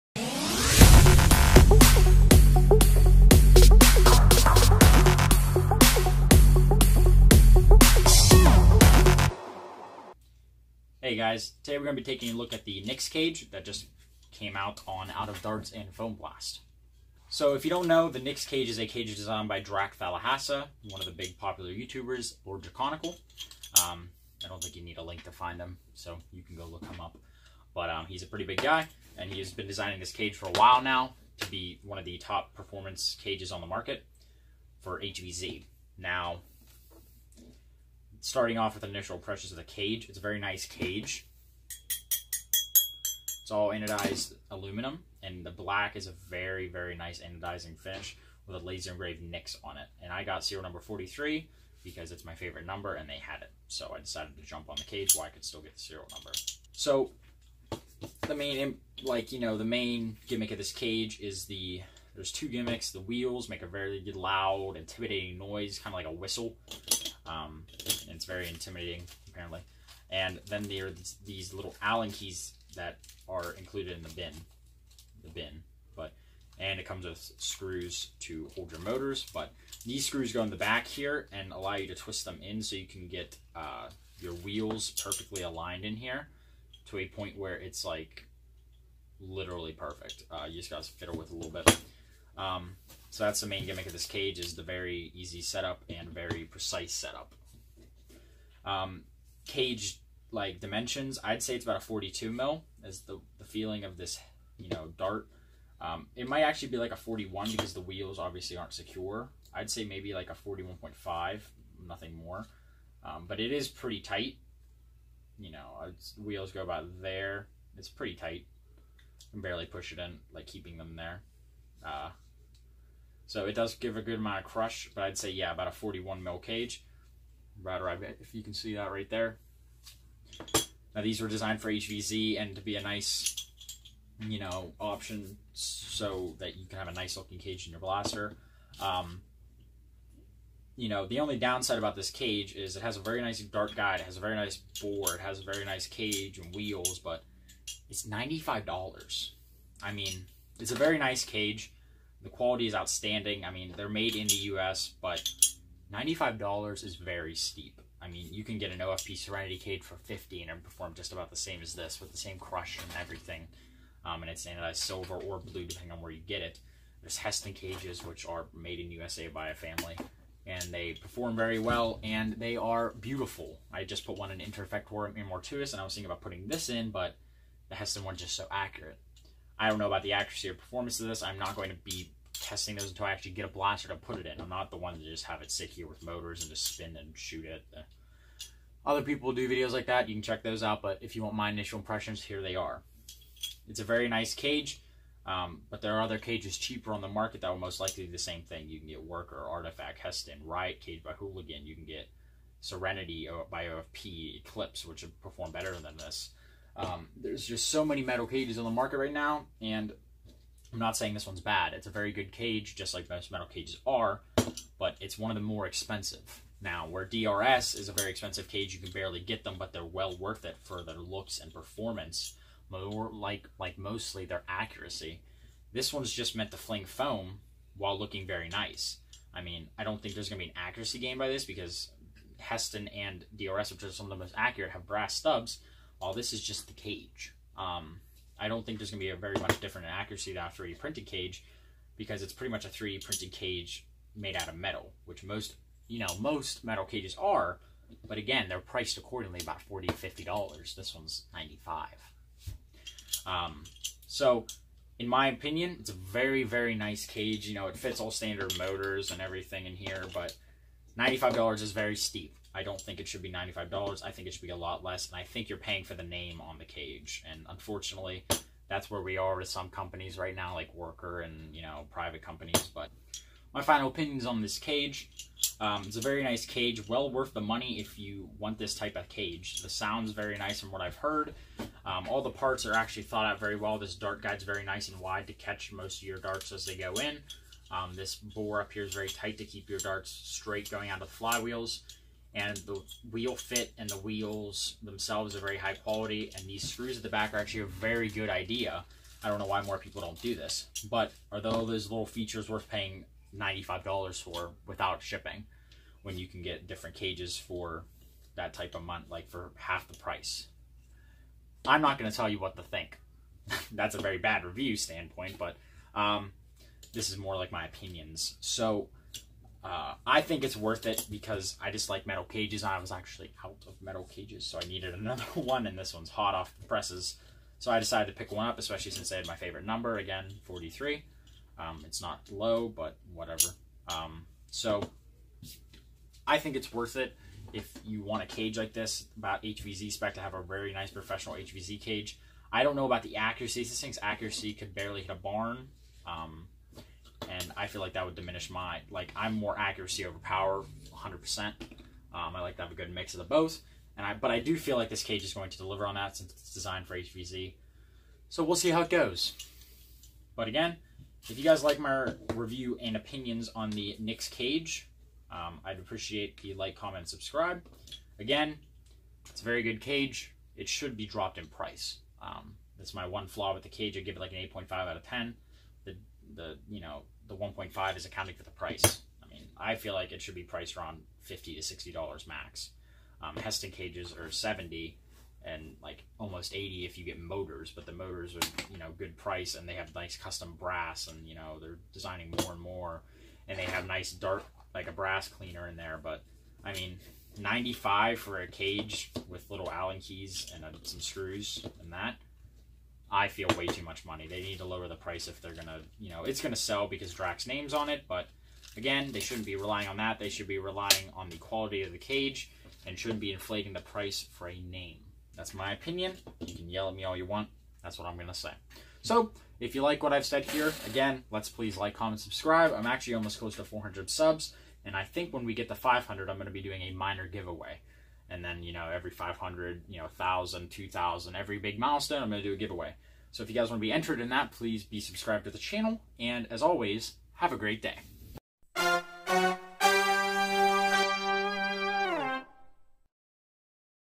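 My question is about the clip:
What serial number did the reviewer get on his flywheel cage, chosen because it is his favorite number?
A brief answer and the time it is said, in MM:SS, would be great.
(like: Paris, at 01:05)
43, at 00:50.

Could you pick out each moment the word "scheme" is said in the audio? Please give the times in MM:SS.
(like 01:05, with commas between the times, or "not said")
not said.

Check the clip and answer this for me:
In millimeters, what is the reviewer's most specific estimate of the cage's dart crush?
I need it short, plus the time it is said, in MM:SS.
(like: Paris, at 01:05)
41.5, at 01:50.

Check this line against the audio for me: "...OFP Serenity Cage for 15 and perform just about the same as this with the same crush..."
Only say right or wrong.
right.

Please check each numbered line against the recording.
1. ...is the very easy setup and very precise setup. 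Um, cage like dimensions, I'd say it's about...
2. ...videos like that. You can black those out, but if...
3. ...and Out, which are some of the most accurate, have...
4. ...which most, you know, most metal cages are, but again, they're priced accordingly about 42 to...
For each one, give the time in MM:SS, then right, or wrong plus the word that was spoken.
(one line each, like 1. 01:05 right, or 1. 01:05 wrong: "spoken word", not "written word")
1. 01:34 right
2. 03:09 wrong: "check", not "black"
3. 03:52 wrong: "DRS", not "Out"
4. 04:05 wrong: "40", not "42".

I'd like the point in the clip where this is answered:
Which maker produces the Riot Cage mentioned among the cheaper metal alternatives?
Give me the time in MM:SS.
03:21.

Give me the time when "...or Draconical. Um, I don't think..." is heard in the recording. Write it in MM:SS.
00:22.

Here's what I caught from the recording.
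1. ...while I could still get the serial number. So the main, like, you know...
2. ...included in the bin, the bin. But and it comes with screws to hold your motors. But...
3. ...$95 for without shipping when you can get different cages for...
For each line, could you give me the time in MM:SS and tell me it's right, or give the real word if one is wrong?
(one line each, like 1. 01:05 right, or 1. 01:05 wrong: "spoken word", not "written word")
1. 00:55 right
2. 01:13 right
3. 05:03 right.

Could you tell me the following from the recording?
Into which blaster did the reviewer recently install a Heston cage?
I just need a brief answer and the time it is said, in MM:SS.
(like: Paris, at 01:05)
Interfectorum Immortuus, at 02:54.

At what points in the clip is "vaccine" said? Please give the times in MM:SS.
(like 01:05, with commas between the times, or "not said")
not said.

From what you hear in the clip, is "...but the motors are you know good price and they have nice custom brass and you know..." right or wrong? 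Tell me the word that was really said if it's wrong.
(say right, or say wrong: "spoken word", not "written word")
right.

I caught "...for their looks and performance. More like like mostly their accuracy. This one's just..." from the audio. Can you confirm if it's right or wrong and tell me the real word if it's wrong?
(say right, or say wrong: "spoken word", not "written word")
right.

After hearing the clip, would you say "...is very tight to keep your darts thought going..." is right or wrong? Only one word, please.
wrong.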